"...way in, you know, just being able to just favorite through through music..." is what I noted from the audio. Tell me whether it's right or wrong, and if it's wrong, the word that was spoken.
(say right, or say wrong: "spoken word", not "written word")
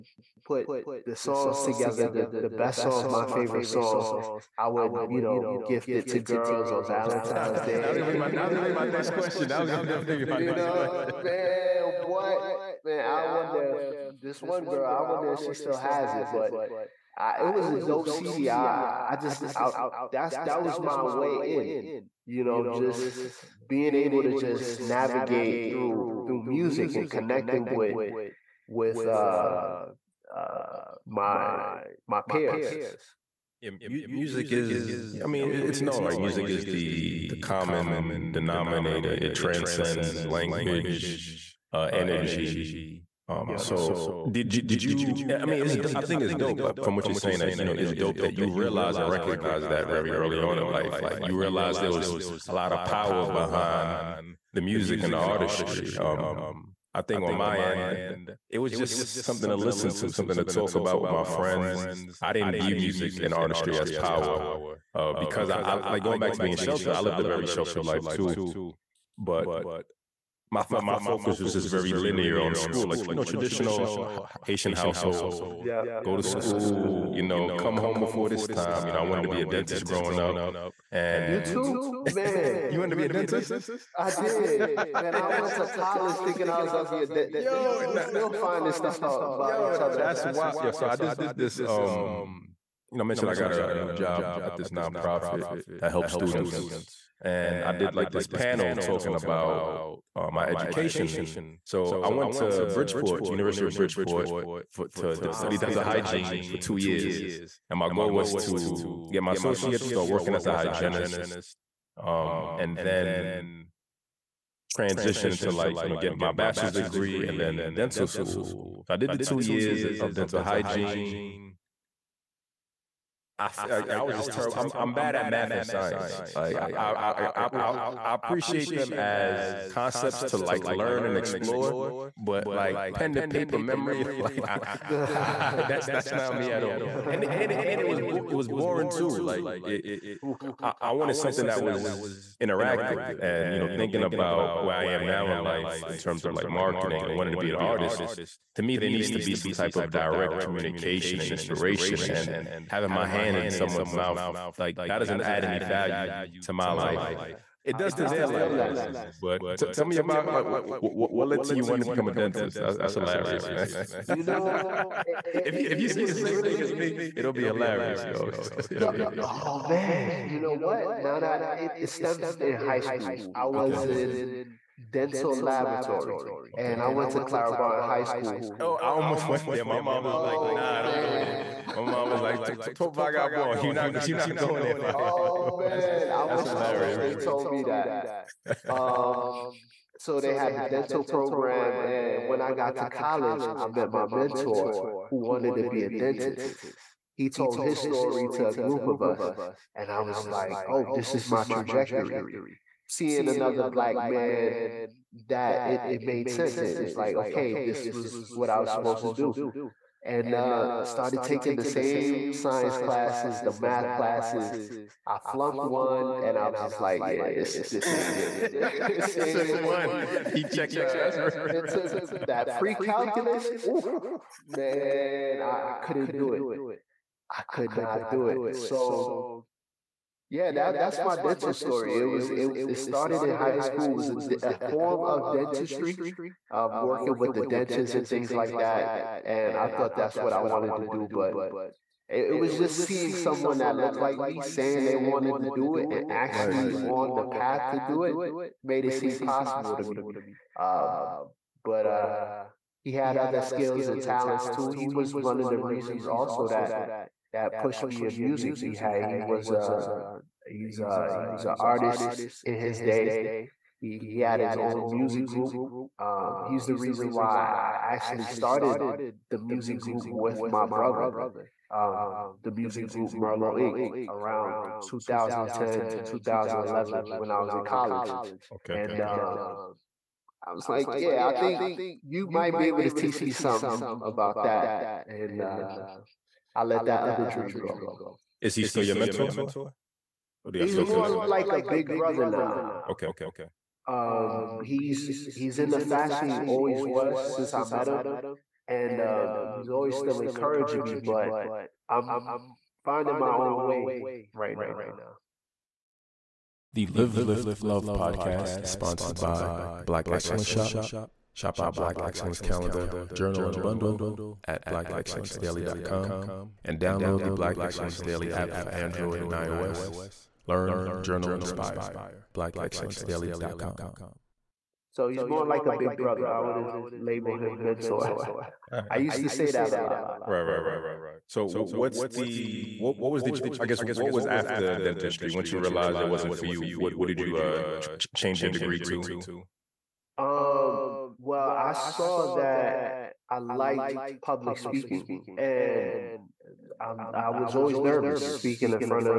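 wrong: "navigate", not "favorite".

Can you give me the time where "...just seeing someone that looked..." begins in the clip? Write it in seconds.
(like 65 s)
242 s.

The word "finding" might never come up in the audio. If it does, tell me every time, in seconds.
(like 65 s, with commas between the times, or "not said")
88 s, 302 s.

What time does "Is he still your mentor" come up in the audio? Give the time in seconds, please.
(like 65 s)
288 s.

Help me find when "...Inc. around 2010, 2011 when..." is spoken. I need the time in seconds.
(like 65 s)
273 s.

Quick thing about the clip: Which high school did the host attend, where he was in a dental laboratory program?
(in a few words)
Clara Barton High School.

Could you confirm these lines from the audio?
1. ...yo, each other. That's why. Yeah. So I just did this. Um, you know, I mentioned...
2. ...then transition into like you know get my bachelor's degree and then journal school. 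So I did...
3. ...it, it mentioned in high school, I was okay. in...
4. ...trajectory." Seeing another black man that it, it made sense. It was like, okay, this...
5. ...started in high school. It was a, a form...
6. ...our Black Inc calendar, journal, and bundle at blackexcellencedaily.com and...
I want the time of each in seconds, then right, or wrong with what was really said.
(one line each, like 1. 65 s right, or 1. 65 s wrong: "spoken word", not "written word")
1. 89 s right
2. 112 s wrong: "dental", not "journal"
3. 171 s wrong: "stemmed", not "mentioned"
4. 201 s right
5. 232 s right
6. 311 s wrong: "Excellence", not "Inc".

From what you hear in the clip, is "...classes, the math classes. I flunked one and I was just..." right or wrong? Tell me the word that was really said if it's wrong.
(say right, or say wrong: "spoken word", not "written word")
right.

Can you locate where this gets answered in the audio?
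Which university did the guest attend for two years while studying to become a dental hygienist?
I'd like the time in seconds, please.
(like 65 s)
103 s.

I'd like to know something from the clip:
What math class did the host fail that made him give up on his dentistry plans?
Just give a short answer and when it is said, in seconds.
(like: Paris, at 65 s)
pre-calculus, at 222 s.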